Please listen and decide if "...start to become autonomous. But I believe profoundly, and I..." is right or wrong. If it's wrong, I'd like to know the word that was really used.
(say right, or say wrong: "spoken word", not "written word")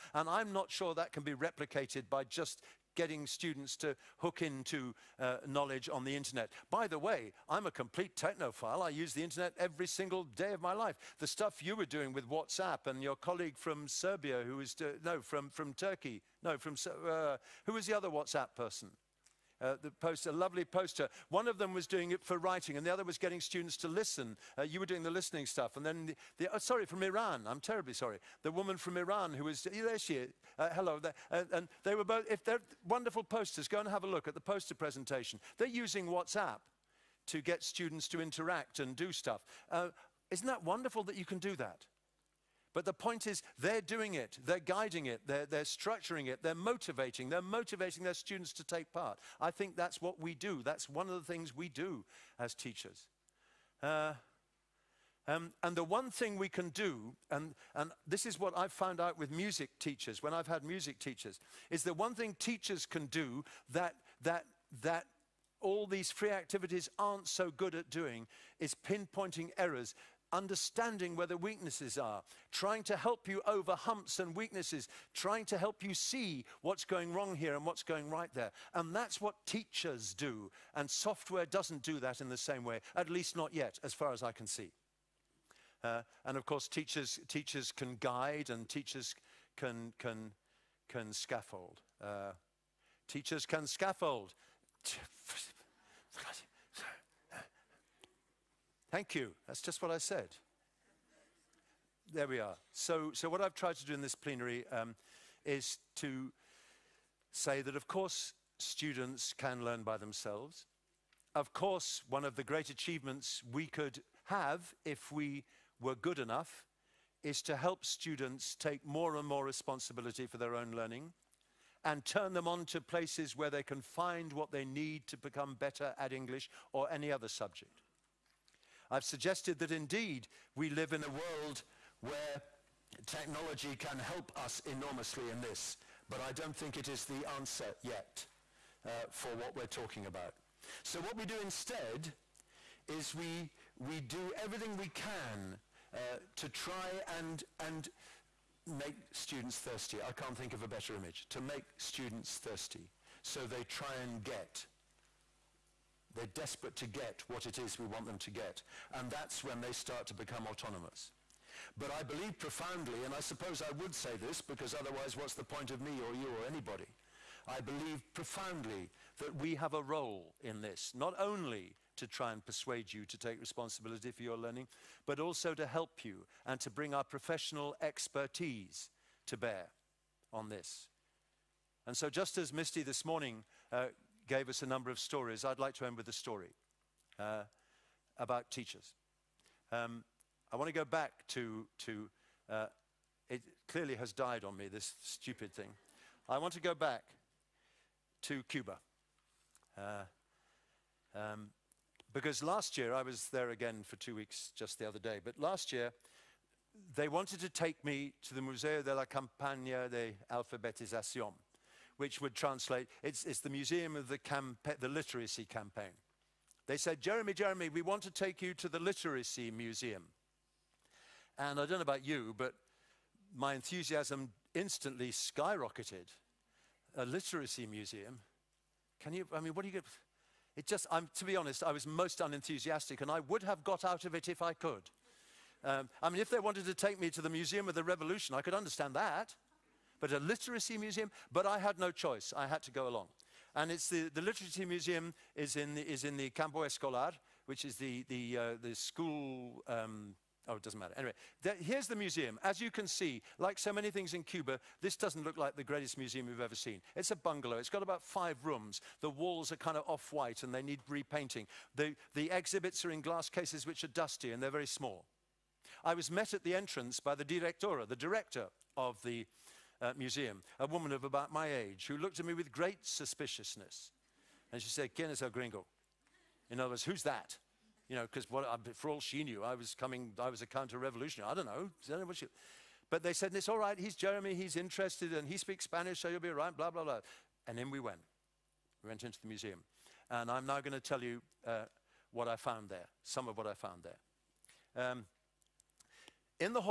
right.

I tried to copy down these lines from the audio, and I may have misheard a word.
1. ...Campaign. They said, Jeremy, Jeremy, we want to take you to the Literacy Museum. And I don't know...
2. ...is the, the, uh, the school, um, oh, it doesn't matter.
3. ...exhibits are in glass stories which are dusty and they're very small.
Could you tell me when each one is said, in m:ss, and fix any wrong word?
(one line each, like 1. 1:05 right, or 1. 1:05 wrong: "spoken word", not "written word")
1. 3:35 right
2. 4:07 right
3. 4:22 wrong: "cases", not "stories".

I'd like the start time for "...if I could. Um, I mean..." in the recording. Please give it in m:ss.
3:54.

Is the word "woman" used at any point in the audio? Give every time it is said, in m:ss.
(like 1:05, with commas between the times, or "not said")
0:28, 4:30.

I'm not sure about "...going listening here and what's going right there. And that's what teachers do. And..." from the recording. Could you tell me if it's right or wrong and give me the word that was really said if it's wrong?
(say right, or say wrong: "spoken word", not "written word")
wrong: "wrong", not "listening".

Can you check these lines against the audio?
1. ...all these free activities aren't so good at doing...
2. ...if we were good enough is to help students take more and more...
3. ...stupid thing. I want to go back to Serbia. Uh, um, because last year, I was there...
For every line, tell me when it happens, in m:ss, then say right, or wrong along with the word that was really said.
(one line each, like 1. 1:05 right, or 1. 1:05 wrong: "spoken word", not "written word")
1. 1:05 right
2. 1:54 right
3. 3:15 wrong: "Cuba", not "Serbia".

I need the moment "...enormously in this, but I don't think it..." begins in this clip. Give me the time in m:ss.
2:14.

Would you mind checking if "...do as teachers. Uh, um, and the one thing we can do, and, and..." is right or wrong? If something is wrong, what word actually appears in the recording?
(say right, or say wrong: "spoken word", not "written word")
right.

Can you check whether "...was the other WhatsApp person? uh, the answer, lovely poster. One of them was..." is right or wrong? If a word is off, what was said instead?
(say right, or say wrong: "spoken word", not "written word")
wrong: "poster", not "answer".